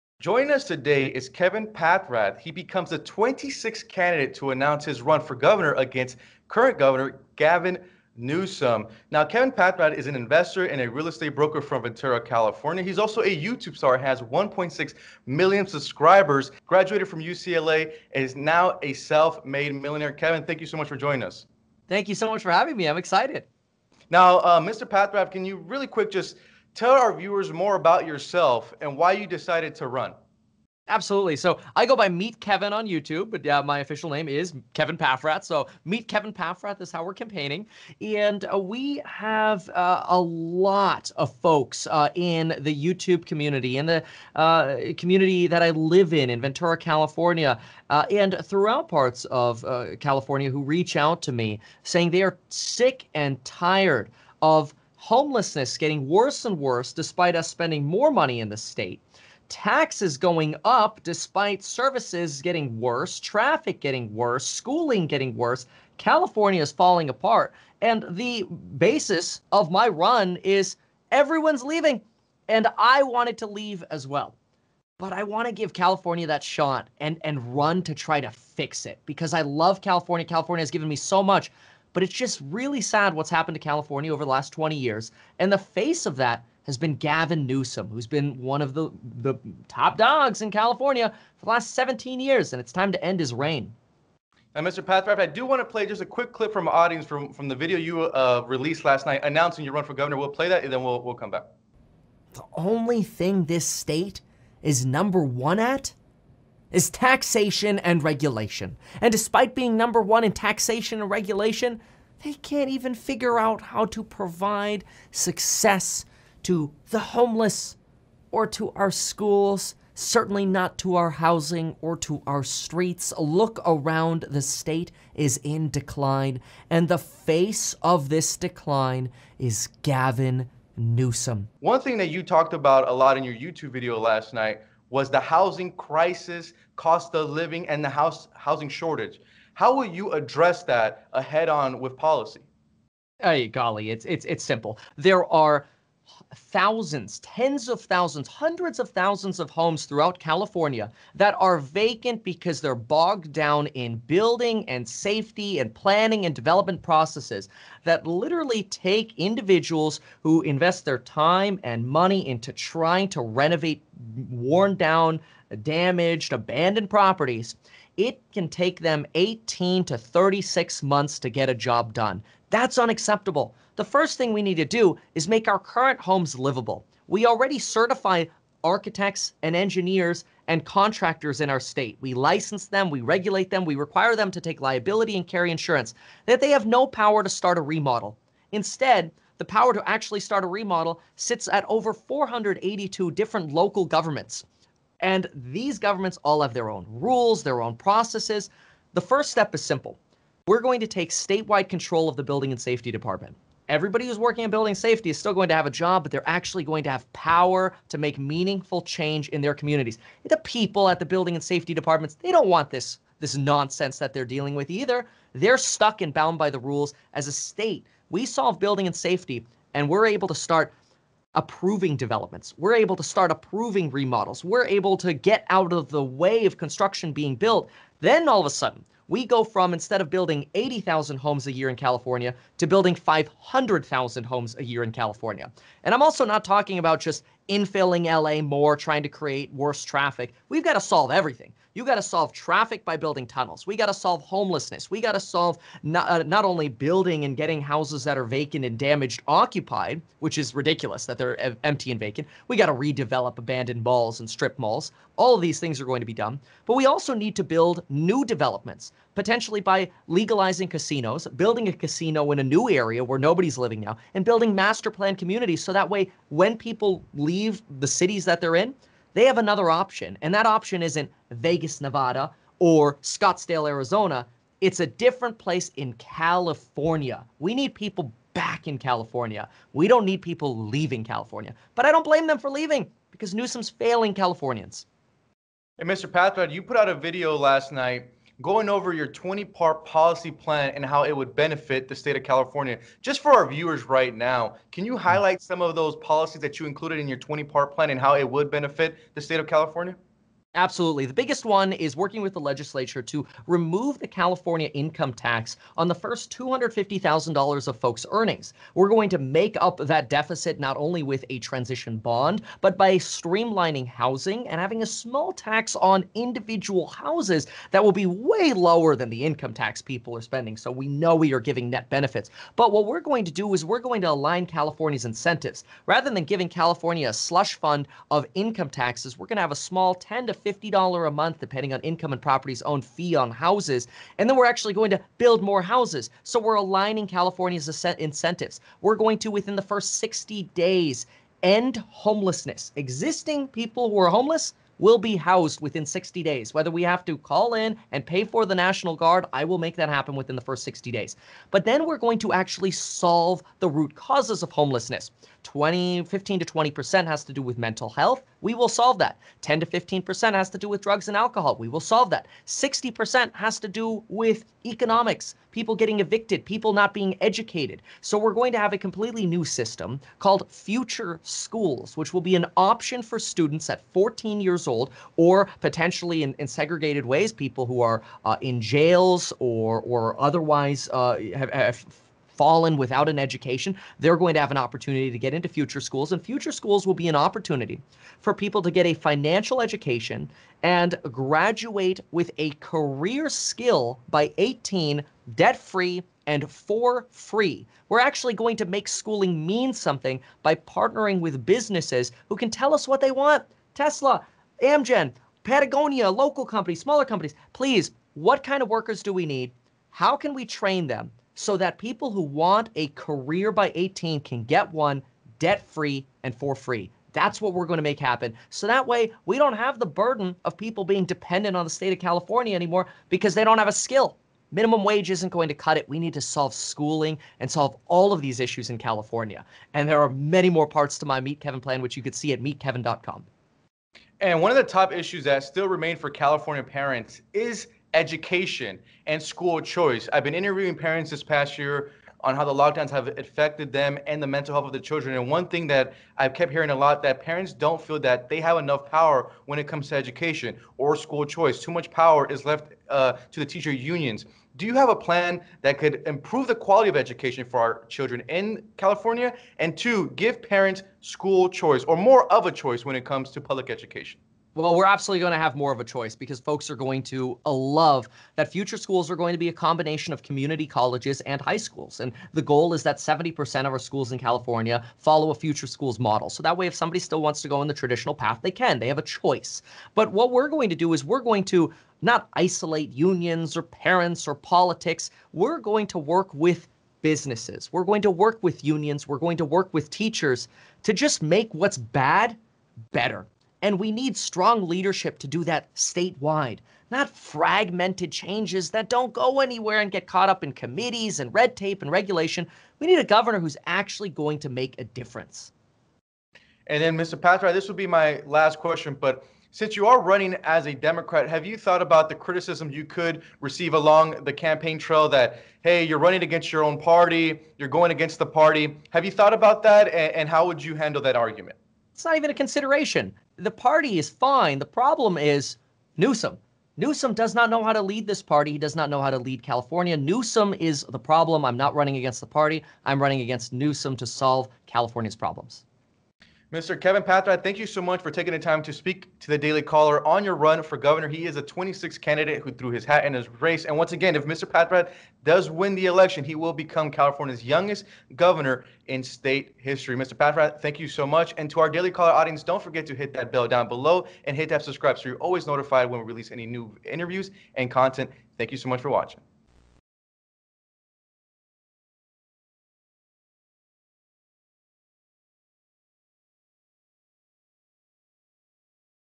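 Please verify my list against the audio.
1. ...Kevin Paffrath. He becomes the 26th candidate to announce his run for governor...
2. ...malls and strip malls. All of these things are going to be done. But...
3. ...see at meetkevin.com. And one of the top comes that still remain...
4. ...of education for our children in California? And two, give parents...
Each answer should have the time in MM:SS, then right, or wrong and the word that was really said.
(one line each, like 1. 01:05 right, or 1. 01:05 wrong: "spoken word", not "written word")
1. 00:01 right
2. 04:13 right
3. 07:12 wrong: "issues", not "comes"
4. 07:36 right.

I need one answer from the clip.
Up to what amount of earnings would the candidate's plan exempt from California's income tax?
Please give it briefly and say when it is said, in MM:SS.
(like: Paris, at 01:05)
$250,000, at 05:06.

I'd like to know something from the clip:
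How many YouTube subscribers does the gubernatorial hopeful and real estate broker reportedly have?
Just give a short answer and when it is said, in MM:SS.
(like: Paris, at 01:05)
1.6 million, at 00:14.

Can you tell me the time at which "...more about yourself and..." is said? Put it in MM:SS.
00:27.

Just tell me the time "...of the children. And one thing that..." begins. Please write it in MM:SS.
07:24.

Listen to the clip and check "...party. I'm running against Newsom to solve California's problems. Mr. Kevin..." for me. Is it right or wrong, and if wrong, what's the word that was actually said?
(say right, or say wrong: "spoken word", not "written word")
right.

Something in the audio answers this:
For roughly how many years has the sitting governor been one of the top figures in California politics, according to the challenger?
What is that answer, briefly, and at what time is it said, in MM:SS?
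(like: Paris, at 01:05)
17 years, at 01:31.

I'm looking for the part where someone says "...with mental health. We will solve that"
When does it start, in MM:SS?
05:57.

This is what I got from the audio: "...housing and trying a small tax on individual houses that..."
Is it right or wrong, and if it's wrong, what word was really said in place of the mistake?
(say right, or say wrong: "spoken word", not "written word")
wrong: "having", not "trying".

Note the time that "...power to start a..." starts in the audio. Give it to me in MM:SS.
03:06.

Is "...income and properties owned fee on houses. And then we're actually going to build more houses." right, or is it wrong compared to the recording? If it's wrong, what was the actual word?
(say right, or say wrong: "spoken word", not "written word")
right.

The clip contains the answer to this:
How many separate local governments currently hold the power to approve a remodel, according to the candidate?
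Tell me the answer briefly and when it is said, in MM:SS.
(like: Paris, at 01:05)
482, at 03:11.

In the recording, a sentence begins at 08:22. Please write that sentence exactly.
We need a governor who's actually going to make a difference.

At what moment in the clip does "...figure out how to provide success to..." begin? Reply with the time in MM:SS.
01:52.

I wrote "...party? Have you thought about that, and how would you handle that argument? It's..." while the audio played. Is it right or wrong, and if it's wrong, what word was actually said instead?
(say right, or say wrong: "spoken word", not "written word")
right.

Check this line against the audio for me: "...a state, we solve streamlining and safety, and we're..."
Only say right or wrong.
wrong.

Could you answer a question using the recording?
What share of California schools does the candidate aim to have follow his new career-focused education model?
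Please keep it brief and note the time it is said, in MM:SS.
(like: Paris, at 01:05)
70%, at 07:52.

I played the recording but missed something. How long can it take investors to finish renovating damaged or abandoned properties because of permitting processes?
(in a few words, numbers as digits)
18 to 36 months.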